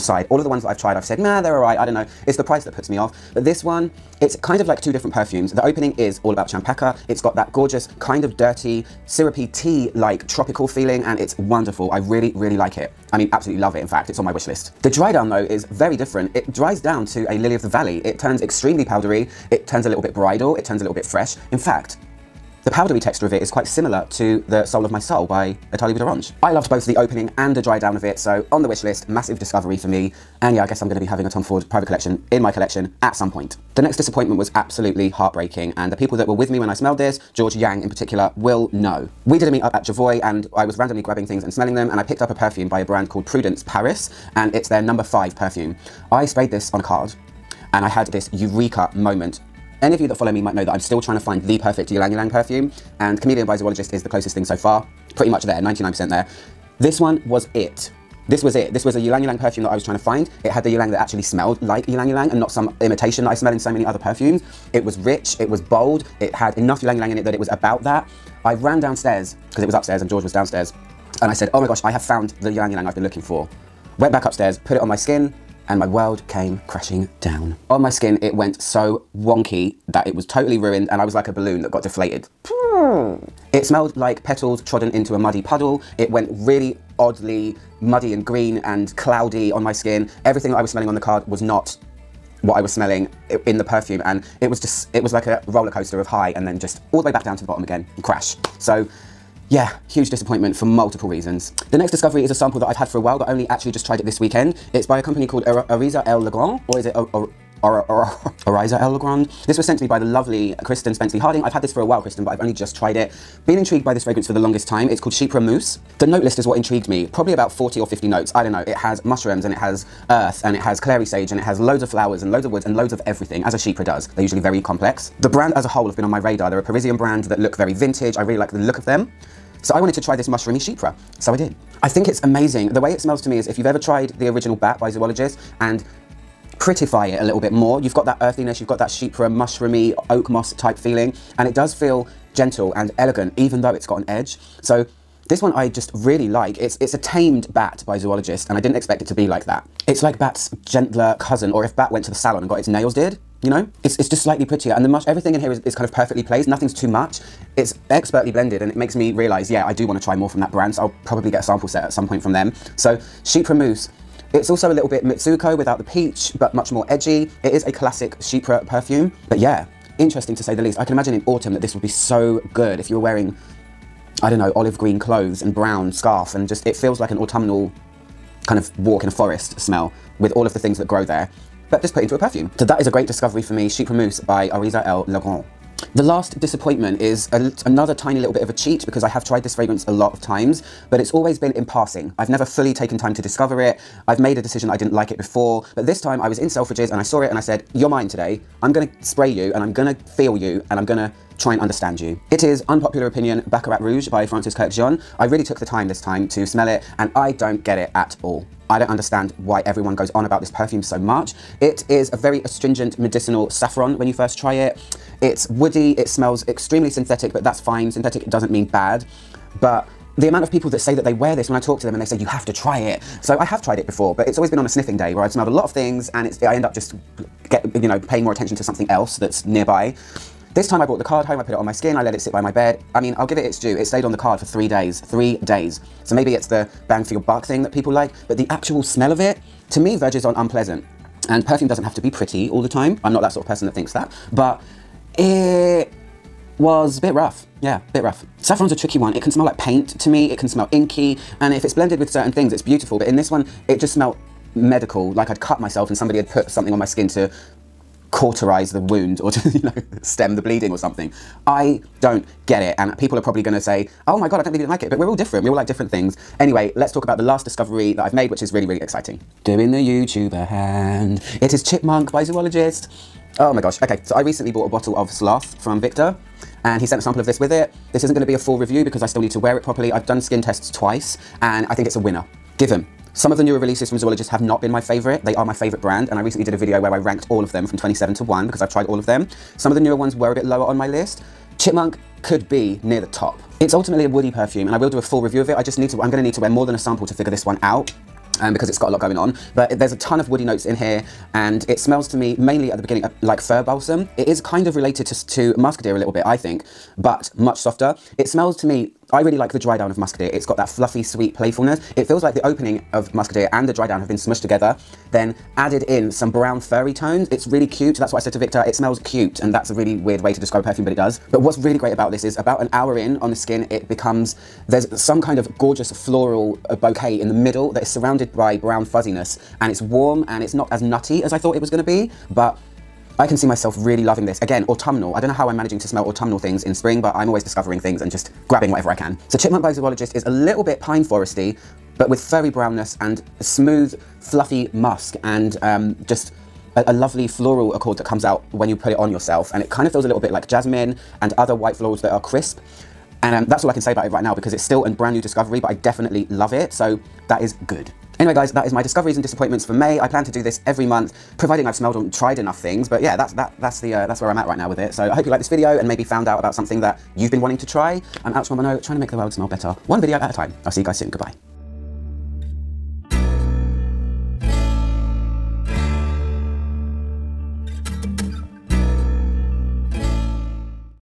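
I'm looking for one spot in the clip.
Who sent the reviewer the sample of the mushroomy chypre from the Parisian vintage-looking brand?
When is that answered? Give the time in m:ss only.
1:50.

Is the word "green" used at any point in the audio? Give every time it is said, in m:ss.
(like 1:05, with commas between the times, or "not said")
1:28, 2:54.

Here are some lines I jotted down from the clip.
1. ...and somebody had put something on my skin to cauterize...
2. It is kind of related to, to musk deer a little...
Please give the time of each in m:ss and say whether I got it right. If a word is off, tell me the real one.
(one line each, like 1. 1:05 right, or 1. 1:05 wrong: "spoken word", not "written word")
1. 4:15 right
2. 5:04 right.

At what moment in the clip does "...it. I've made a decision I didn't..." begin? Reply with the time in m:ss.
3:13.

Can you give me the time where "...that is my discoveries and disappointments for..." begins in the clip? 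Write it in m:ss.
5:58.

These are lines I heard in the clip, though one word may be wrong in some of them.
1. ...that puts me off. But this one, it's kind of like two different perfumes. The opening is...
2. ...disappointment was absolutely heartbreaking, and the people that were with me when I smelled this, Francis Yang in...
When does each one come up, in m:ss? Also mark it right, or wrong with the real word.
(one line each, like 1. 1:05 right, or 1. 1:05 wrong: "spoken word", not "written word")
1. 0:02 right
2. 0:33 wrong: "George", not "Francis".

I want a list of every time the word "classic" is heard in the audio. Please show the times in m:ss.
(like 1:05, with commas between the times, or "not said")
2:47.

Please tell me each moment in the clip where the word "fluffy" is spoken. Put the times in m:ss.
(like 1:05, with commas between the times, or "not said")
5:10, 5:44.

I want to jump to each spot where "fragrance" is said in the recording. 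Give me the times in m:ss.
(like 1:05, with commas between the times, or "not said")
1:54, 3:09.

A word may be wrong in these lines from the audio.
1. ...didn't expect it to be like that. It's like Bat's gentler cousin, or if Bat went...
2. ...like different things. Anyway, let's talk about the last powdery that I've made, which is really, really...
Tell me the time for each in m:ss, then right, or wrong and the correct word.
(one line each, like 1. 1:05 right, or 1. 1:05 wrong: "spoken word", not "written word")
1. 2:28 right
2. 4:25 wrong: "discovery", not "powdery".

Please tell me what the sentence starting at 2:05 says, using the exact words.
The brand as a whole have been on my radar.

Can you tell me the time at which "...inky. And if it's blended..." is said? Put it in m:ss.
4:10.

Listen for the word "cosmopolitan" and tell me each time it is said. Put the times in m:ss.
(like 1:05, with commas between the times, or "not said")
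not said.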